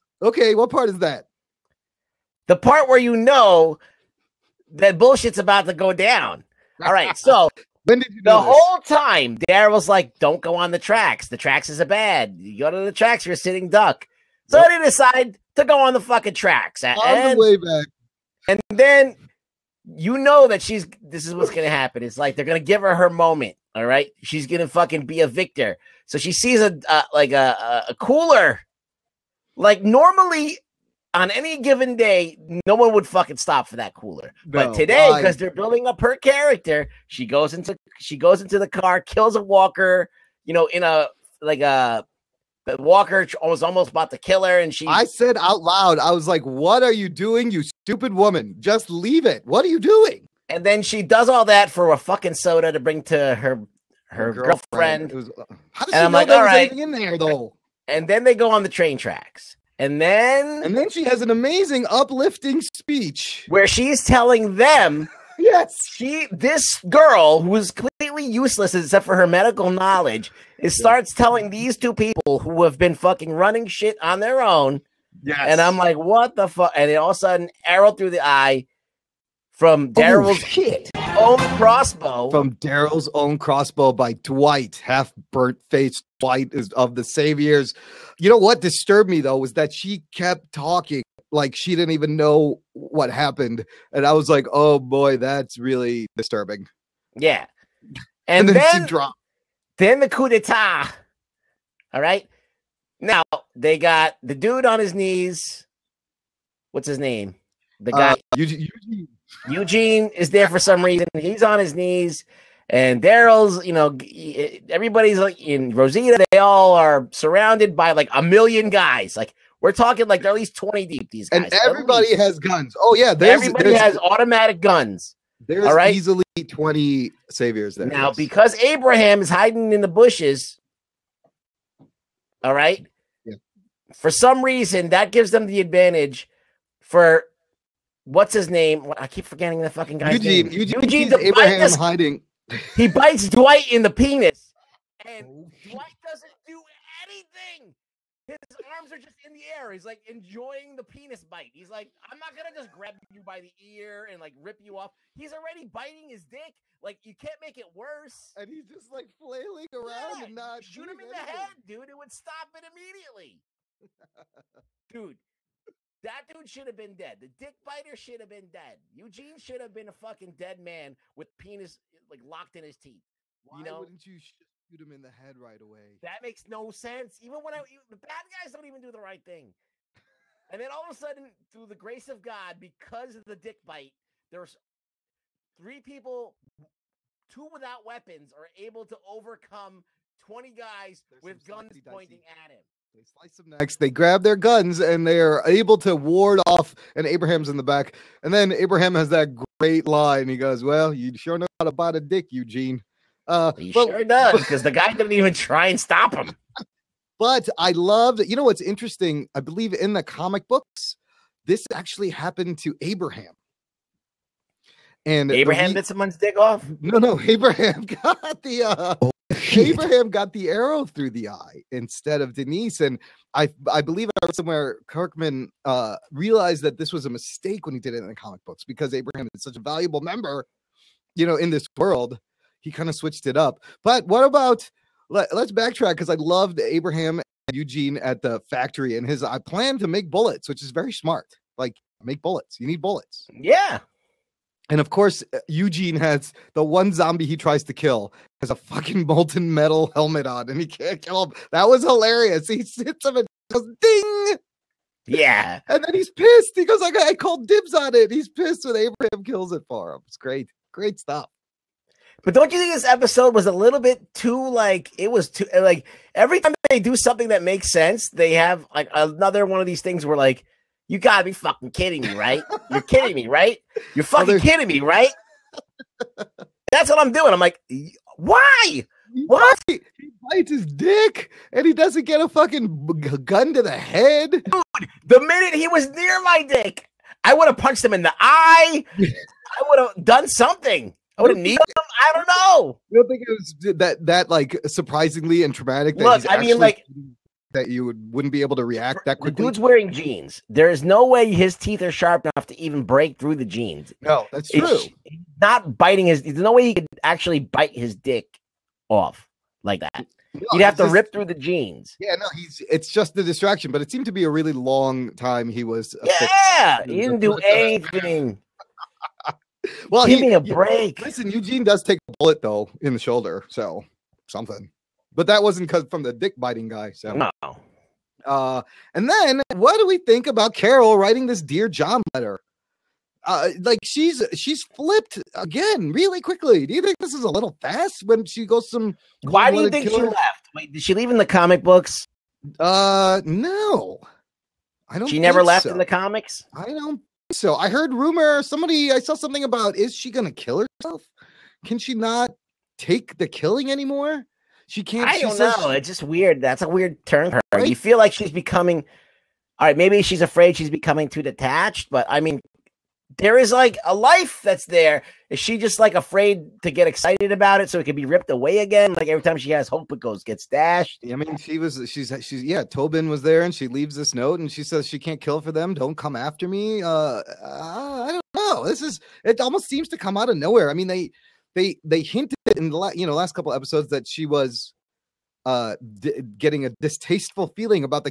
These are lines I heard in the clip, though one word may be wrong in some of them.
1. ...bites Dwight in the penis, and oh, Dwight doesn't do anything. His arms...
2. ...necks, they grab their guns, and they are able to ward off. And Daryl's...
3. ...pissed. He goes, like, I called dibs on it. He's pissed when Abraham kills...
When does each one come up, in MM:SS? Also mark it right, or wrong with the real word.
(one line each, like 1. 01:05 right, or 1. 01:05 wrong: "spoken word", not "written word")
1. 02:22 right
2. 03:13 wrong: "Abraham", not "Daryl"
3. 04:16 right.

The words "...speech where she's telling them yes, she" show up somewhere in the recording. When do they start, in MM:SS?
01:02.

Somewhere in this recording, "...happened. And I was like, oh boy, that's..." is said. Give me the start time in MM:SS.
01:33.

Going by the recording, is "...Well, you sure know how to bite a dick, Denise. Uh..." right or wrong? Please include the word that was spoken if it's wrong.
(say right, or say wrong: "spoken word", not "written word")
wrong: "Eugene", not "Denise".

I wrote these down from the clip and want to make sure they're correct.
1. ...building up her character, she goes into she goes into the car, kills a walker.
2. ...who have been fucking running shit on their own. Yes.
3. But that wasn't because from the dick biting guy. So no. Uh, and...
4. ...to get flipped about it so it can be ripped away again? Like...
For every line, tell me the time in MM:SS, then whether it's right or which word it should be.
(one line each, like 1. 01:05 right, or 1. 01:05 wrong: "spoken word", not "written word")
1. 00:35 right
2. 01:12 right
3. 05:25 right
4. 06:06 wrong: "excited", not "flipped".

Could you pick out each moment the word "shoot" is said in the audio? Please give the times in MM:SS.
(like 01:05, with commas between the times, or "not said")
02:40, 02:54.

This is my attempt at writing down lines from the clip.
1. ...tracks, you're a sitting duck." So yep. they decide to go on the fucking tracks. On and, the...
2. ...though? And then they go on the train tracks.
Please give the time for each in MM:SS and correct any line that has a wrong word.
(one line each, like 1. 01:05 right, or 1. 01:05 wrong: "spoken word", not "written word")
1. 00:12 right
2. 00:57 right.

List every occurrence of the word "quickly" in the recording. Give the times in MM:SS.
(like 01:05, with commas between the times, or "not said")
04:59, 05:36.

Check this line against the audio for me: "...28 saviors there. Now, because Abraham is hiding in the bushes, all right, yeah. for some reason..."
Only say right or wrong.
wrong.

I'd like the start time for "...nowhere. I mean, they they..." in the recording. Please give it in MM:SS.
06:20.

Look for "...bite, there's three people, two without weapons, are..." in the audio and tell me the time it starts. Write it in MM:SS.
03:03.